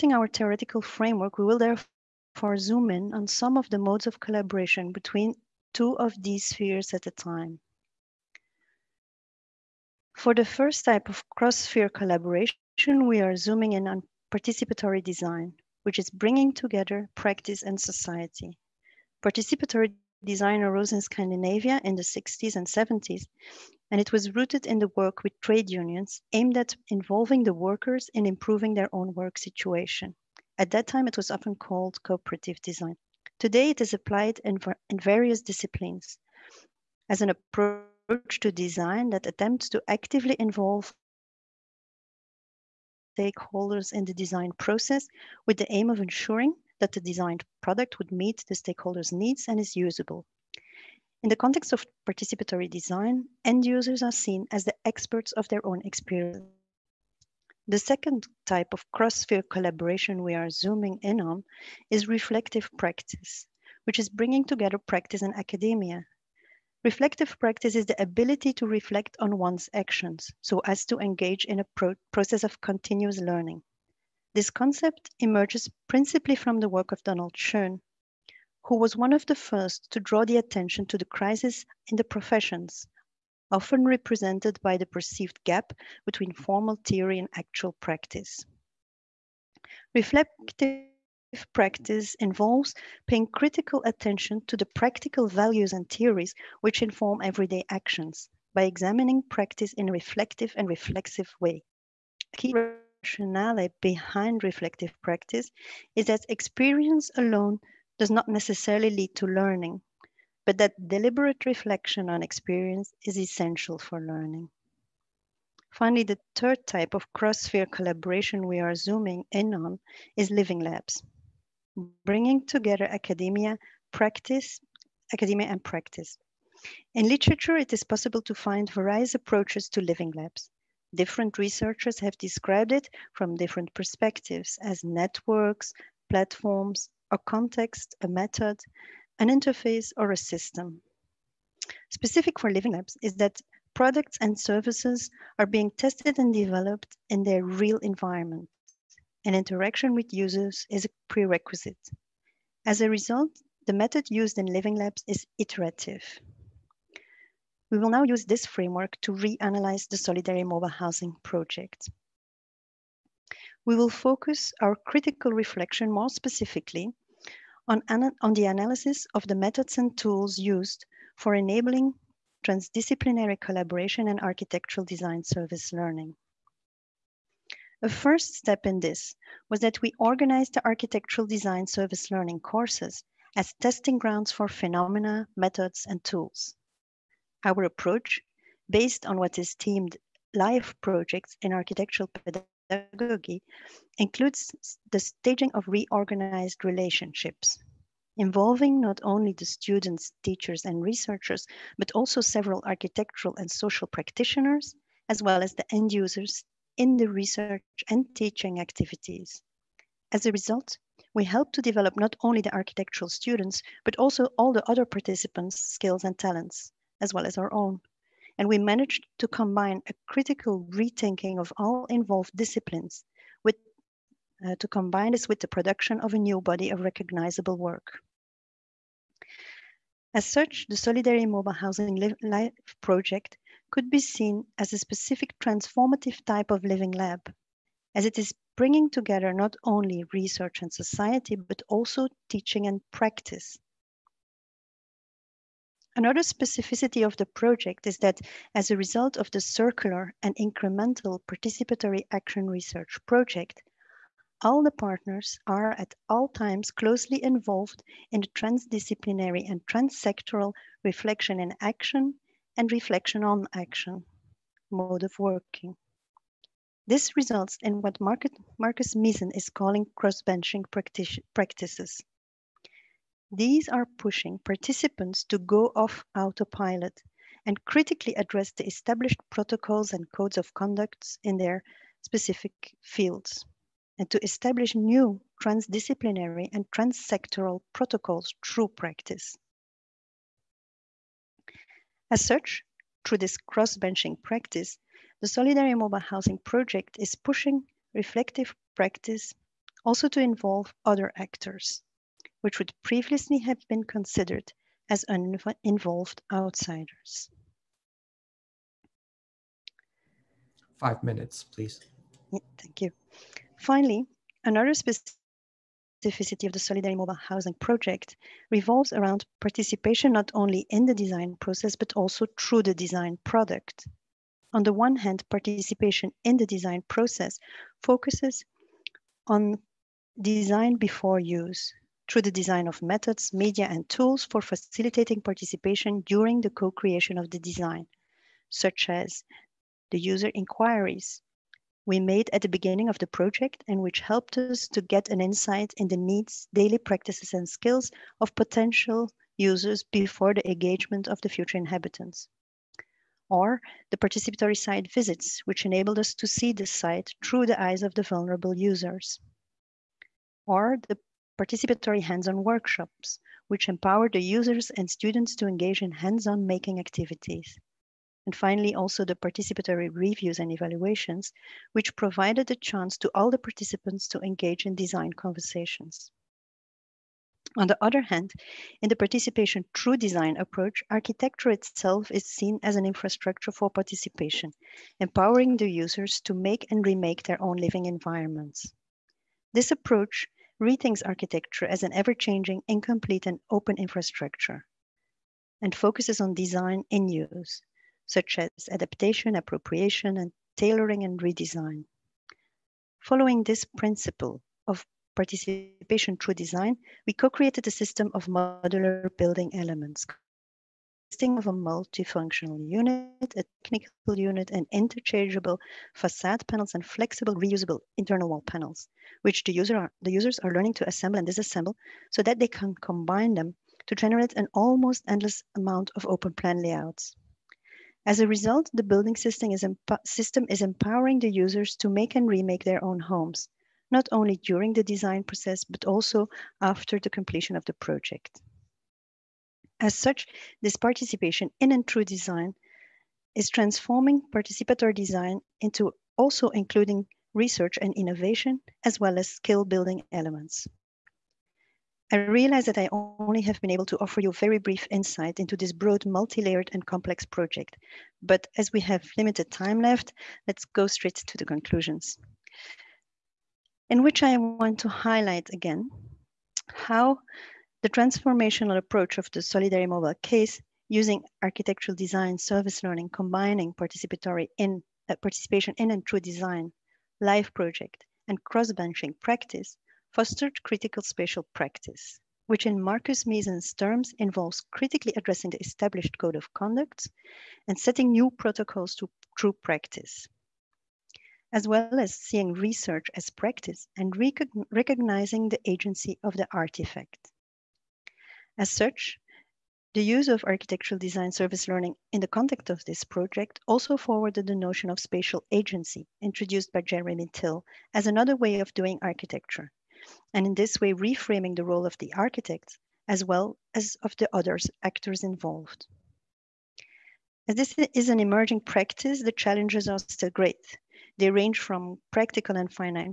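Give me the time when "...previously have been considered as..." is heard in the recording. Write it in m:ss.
5:02.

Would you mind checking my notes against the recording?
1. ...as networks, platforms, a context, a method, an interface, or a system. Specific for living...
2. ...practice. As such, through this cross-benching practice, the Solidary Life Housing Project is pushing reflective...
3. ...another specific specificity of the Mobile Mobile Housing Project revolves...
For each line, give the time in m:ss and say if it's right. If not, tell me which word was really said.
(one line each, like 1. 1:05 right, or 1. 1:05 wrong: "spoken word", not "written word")
1. 2:14 right
2. 4:48 wrong: "Mobile", not "Life"
3. 5:14 wrong: "Solidary", not "Mobile".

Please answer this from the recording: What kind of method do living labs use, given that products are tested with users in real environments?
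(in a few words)
iterative.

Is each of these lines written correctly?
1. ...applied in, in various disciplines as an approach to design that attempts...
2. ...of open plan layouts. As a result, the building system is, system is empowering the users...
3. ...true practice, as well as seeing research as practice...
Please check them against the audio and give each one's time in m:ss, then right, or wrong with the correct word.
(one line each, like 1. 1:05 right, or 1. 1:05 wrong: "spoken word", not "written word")
1. 0:33 right
2. 7:05 right
3. 8:09 right.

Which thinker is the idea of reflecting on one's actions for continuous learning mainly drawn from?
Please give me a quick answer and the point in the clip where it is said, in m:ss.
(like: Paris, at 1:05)
Donald Schoen, at 1:17.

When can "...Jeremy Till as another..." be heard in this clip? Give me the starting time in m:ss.
8:26.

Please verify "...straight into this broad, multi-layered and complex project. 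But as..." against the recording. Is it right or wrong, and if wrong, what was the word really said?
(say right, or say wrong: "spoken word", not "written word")
wrong: "insight", not "straight".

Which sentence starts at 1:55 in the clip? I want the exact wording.
Finally, the third type of cross-sphere collaboration we are zooming in on is living labs bringing together academia, practice, academia and practice.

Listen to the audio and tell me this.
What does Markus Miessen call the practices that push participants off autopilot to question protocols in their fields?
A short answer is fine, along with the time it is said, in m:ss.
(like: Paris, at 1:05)
cross-benching practices, at 4:29.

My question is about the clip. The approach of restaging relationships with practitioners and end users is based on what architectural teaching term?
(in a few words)
live projects.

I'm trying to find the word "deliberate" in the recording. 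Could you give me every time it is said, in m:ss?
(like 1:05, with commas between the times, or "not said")
1:50.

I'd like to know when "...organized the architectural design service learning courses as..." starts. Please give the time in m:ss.
2:59.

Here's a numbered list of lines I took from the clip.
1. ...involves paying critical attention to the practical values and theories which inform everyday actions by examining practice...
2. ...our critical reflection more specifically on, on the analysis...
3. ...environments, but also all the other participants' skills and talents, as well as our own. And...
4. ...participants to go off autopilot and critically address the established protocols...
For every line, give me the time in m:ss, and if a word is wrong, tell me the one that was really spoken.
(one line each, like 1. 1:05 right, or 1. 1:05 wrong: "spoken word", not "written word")
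1. 1:32 right
2. 2:44 right
3. 3:33 wrong: "students", not "environments"
4. 4:34 right.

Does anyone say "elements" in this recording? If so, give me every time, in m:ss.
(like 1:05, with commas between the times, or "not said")
6:49, 7:30.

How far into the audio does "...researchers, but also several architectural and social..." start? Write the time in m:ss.
3:20.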